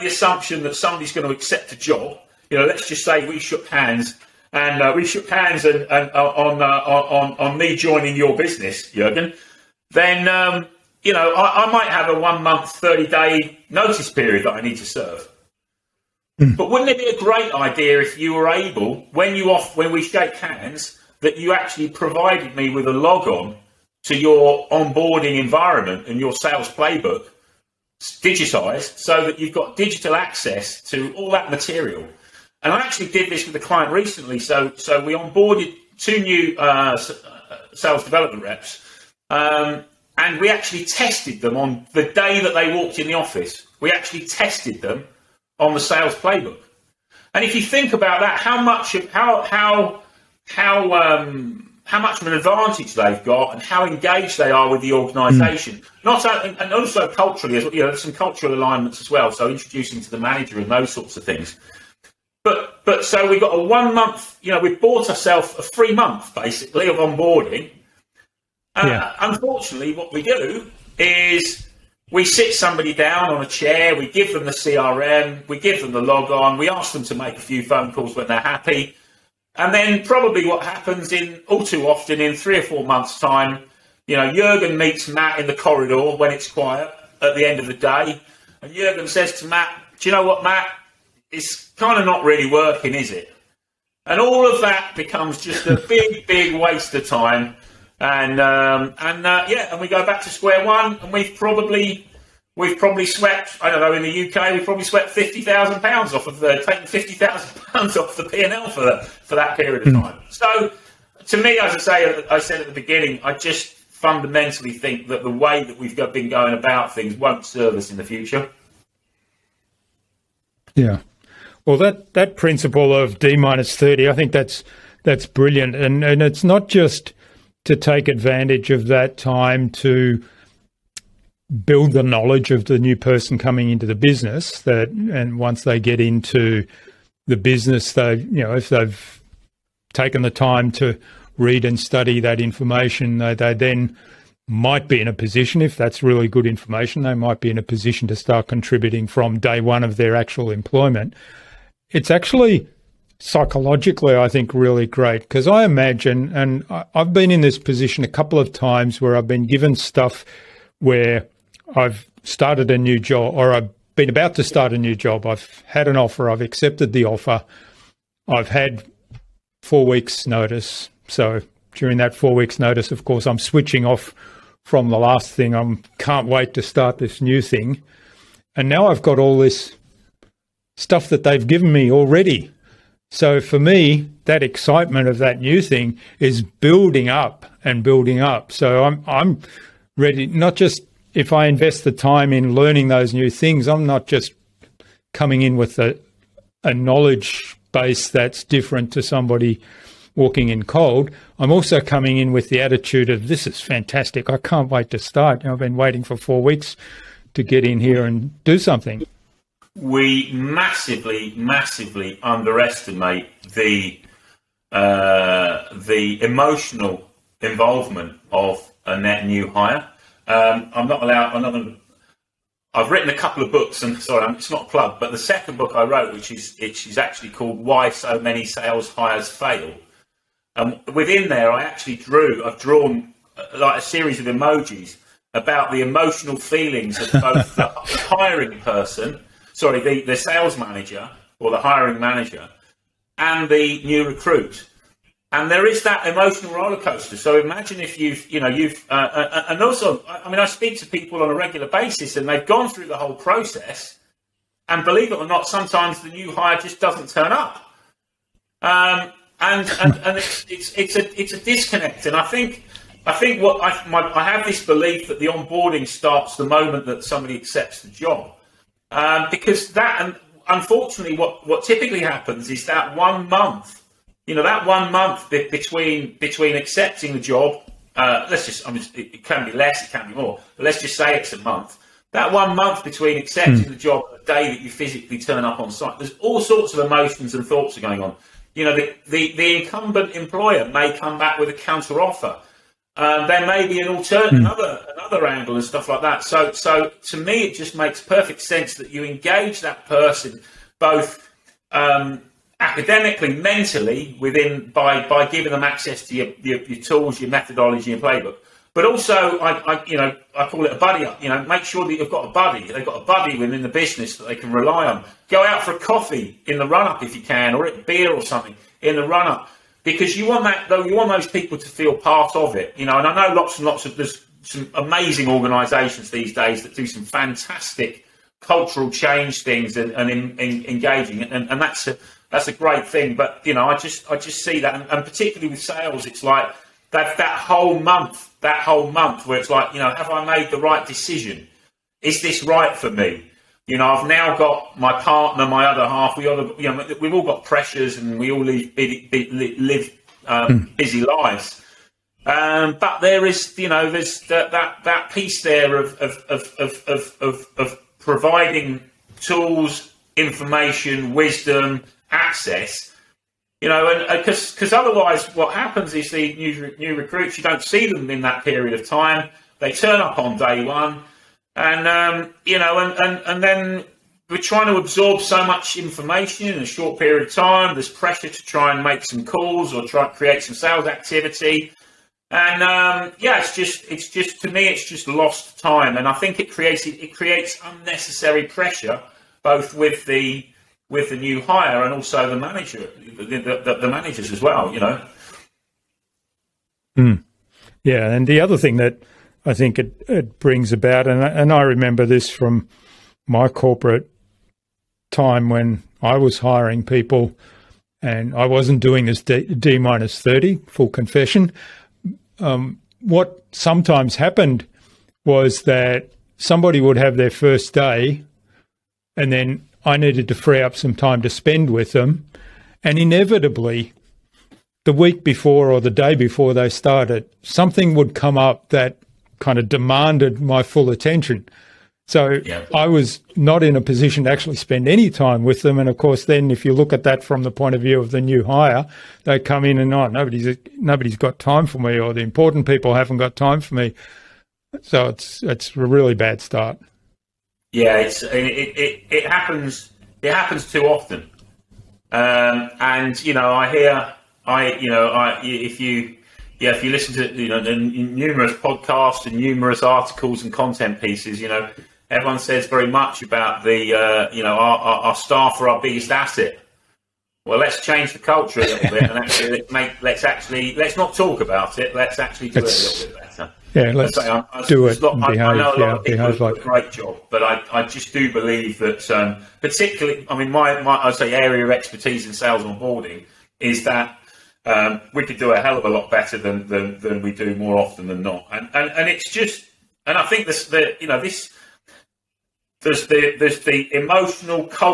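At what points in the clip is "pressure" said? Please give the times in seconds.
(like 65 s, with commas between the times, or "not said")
347 s, 377 s, 388 s.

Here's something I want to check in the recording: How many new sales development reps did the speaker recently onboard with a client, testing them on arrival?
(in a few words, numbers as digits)
2.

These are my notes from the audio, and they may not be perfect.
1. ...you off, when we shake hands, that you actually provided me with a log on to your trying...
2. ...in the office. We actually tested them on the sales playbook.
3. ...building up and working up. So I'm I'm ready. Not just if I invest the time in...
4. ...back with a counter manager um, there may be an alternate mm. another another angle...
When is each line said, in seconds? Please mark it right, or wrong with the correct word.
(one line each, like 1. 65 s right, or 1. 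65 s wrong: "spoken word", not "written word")
1. 19 s wrong: "onboarding", not "trying"
2. 42 s right
3. 186 s wrong: "building", not "working"
4. 291 s wrong: "offer", not "manager".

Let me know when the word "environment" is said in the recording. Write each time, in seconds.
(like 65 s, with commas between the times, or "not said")
25 s.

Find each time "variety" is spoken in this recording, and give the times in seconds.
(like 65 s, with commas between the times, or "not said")
not said.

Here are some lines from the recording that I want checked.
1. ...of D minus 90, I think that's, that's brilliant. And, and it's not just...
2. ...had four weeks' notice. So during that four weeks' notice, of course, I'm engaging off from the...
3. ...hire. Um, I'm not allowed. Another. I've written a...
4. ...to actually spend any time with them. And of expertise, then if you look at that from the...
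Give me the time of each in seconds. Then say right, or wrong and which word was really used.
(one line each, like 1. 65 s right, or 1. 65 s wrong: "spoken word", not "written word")
1. 122 s wrong: "30", not "90"
2. 168 s wrong: "switching", not "engaging"
3. 219 s right
4. 434 s wrong: "course", not "expertise".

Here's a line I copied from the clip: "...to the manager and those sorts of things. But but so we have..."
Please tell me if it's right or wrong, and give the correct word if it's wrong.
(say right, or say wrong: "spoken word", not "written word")
right.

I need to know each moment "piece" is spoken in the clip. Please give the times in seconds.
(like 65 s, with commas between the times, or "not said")
355 s, 460 s.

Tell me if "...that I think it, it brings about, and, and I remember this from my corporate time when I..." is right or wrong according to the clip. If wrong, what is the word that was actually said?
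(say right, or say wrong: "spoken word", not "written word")
right.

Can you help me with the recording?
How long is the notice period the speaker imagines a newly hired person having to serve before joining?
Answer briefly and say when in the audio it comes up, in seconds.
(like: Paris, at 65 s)
30 days, at 12 s.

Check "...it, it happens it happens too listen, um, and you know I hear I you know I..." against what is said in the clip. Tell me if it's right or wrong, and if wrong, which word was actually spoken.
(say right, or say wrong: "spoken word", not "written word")
wrong: "often", not "listen".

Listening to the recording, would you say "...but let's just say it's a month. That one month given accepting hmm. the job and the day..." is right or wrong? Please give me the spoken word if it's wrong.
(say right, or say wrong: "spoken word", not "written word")
wrong: "between", not "given".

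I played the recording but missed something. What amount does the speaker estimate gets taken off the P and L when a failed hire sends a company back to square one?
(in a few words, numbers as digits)
£50,000.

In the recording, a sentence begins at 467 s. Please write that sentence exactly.
Well, let's change the culture a little bit and actually let's make let's actually let's not talk about it.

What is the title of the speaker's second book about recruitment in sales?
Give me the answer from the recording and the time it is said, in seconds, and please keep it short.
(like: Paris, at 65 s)
Why So Many Sales Hires Fail, at 227 s.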